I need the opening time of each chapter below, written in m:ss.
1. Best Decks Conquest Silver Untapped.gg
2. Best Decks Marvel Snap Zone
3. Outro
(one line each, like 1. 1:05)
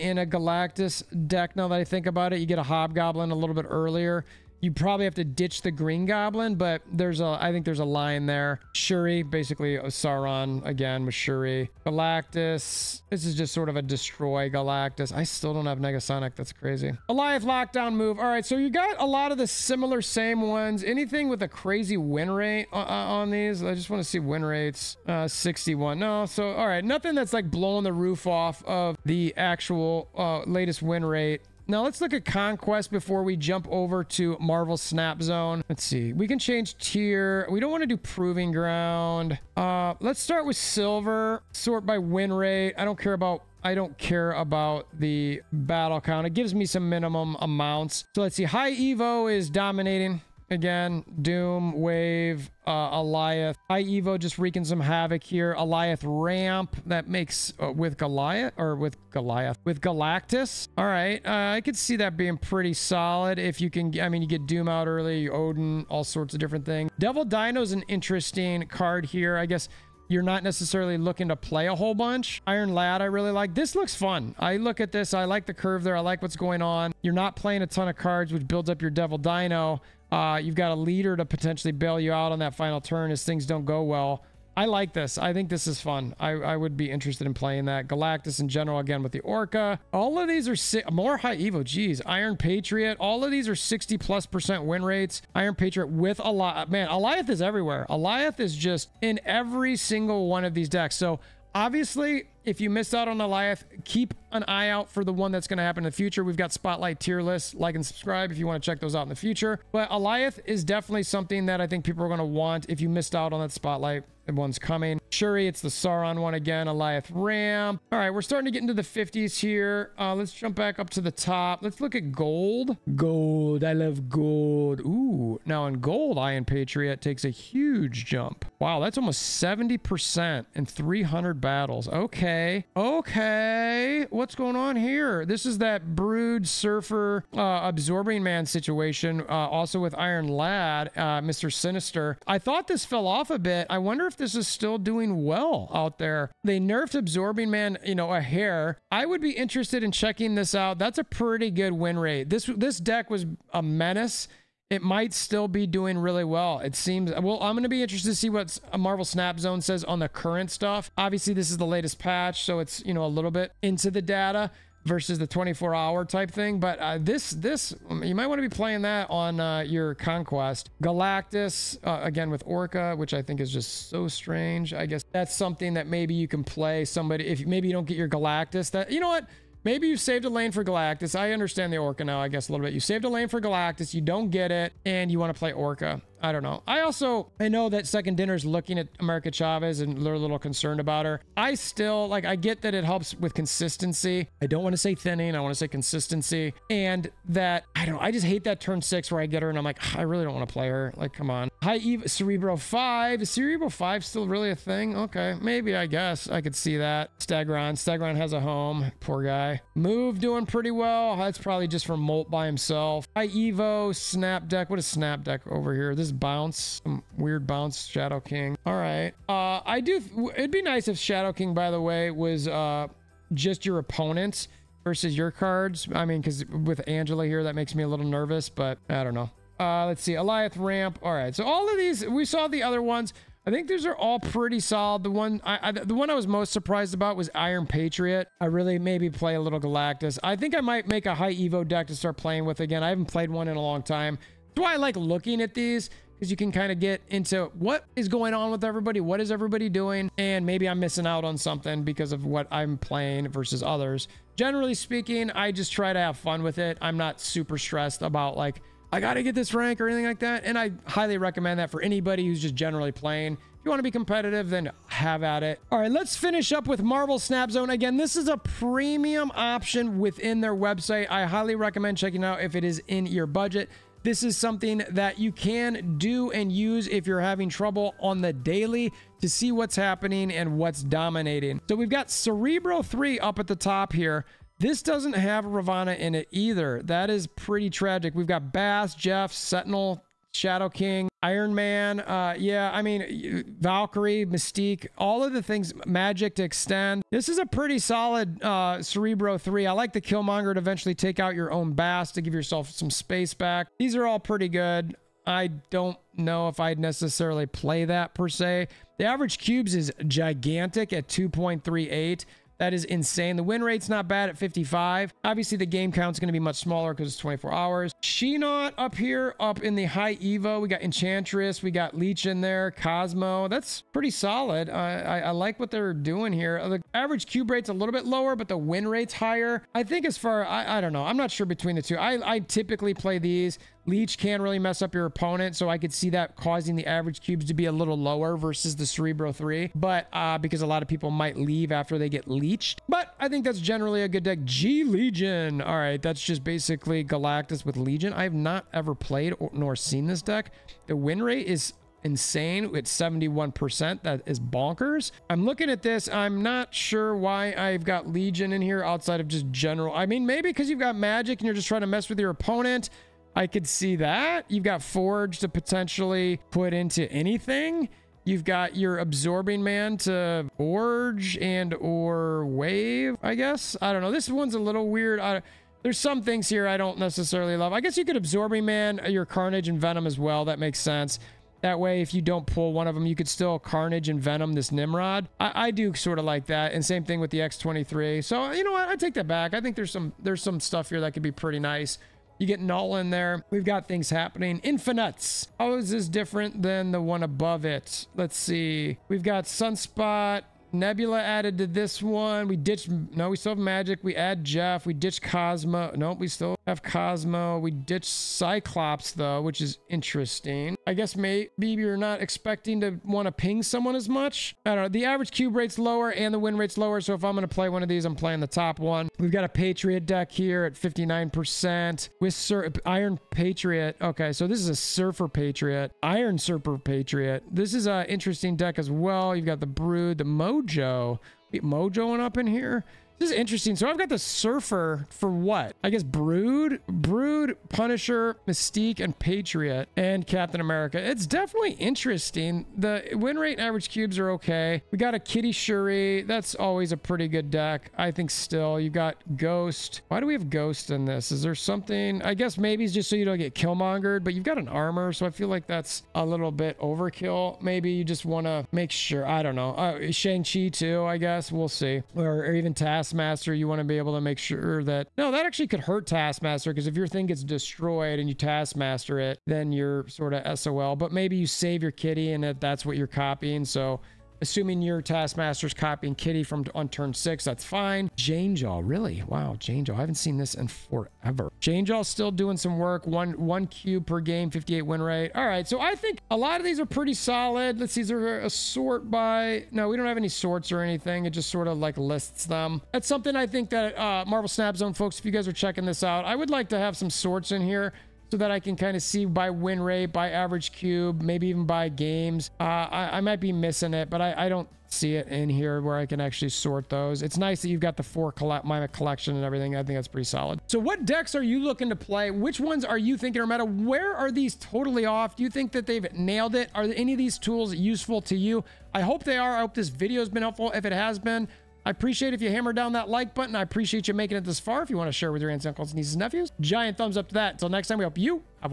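1. 0:31
2. 4:24
3. 8:29.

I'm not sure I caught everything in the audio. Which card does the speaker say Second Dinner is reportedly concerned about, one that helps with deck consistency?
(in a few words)
America Chavez.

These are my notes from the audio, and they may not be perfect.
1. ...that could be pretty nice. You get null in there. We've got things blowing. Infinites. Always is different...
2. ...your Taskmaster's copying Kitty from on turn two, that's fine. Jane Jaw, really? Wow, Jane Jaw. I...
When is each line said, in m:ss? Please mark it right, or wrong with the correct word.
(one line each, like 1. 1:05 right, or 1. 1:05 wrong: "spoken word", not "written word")
1. 6:31 wrong: "happening", not "blowing"
2. 7:54 wrong: "six", not "two".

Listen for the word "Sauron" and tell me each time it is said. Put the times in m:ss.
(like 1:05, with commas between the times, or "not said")
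0:09, 1:55.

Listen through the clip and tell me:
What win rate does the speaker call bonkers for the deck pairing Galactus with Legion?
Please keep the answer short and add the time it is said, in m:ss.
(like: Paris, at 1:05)
71%, at 5:52.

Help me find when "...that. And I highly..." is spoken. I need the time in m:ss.
4:20.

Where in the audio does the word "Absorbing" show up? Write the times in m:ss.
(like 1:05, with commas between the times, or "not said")
2:17, 2:26, 6:08, 6:18.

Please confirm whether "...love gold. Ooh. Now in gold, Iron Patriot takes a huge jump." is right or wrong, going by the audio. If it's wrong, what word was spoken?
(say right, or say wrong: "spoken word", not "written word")
right.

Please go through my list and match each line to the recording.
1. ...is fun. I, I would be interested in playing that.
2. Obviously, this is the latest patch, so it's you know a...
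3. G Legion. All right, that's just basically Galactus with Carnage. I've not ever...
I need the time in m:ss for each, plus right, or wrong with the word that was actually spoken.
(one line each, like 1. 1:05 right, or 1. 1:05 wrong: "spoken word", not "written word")
1. 1:25 right
2. 2:40 right
3. 5:44 wrong: "Legion", not "Carnage".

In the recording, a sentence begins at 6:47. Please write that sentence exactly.
We ditch Cyclops, though, which is interesting.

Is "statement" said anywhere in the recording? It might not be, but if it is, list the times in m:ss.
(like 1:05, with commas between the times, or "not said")
not said.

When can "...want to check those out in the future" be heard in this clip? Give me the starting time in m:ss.
1:48.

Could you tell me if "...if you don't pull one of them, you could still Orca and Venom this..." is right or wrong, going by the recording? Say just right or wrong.
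wrong.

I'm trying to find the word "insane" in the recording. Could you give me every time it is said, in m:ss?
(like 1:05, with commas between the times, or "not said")
5:12, 5:52.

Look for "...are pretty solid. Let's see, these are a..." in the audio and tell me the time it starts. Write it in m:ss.
8:06.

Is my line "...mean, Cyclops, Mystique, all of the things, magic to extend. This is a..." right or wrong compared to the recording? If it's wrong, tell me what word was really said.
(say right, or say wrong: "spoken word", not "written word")
wrong: "Valkyrie", not "Cyclops".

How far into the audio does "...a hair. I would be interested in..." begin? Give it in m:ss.
2:28.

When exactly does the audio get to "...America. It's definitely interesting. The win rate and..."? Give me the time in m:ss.
7:20.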